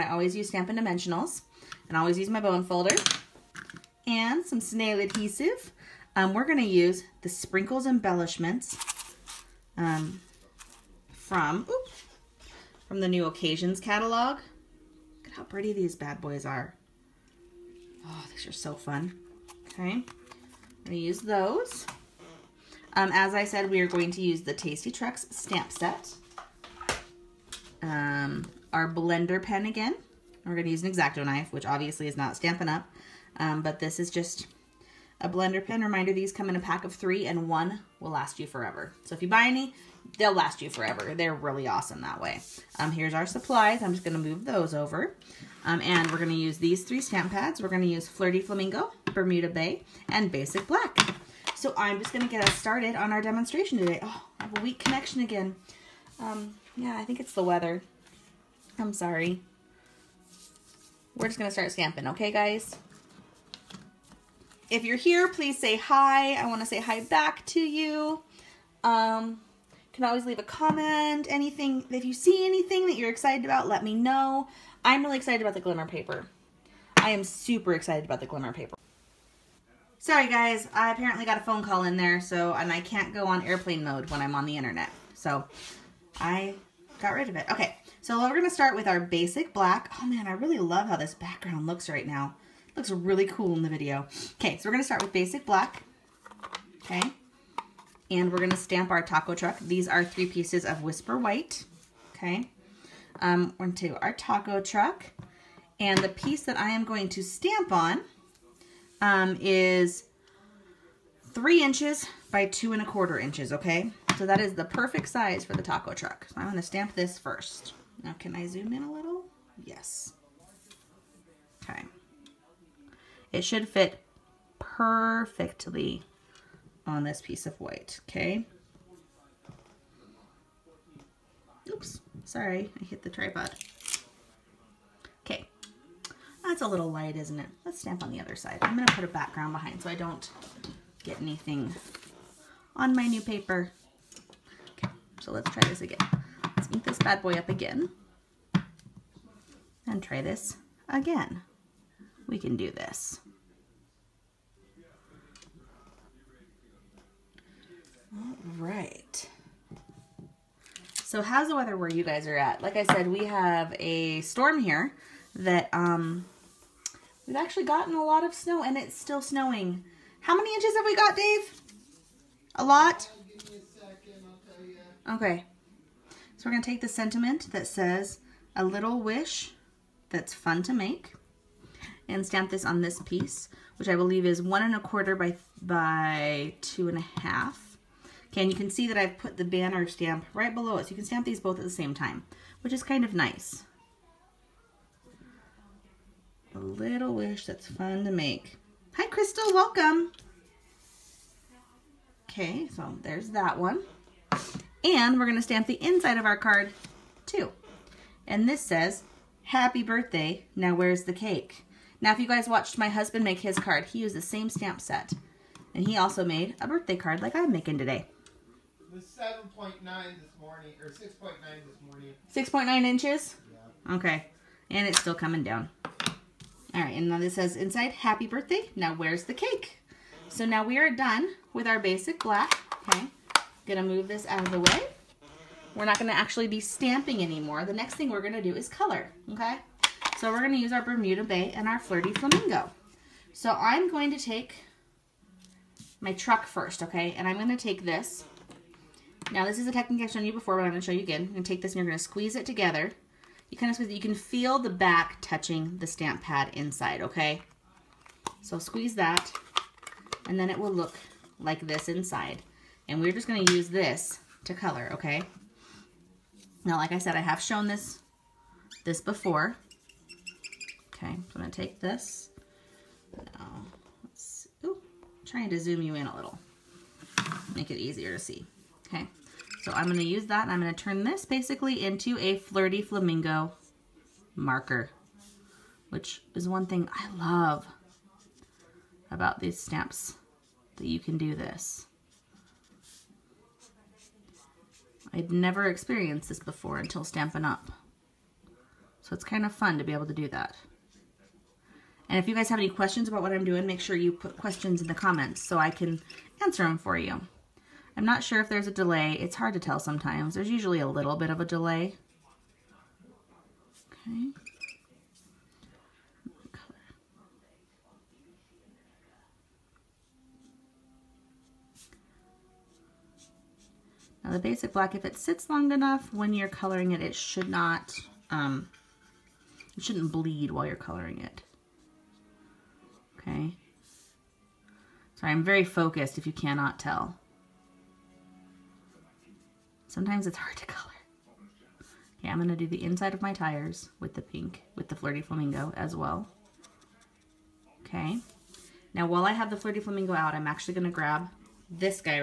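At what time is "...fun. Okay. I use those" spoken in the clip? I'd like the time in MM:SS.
00:18.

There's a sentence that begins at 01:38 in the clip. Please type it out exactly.
And we're gonna stamp our taco truck.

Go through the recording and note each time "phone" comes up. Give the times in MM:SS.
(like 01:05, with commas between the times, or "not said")
01:21.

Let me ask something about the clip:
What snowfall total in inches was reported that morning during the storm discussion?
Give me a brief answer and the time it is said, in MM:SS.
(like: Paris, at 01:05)
6.9 inches, at 03:42.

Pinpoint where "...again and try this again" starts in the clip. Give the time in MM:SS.
02:27.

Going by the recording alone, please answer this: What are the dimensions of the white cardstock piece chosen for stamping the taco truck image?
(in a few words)
3 by 2 1/4 inches.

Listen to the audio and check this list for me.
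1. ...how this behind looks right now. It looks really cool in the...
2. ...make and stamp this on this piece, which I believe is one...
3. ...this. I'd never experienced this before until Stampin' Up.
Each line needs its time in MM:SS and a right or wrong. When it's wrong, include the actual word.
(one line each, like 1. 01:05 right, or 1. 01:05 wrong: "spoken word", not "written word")
1. 01:30 wrong: "background", not "behind"
2. 03:00 right
3. 04:51 right.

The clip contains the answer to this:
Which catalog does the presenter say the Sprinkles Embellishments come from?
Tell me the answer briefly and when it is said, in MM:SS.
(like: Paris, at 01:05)
New Occasions, at 00:13.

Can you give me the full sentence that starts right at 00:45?
Um, and we're going to use these three stamp pads.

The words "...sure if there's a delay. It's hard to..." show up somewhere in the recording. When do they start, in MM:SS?
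05:08.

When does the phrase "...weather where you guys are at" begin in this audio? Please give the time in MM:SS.
02:41.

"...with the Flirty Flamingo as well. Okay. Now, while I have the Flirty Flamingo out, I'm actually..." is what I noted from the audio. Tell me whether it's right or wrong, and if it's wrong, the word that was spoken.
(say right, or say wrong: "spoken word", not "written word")
right.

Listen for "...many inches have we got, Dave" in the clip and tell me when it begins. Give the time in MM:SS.
02:50.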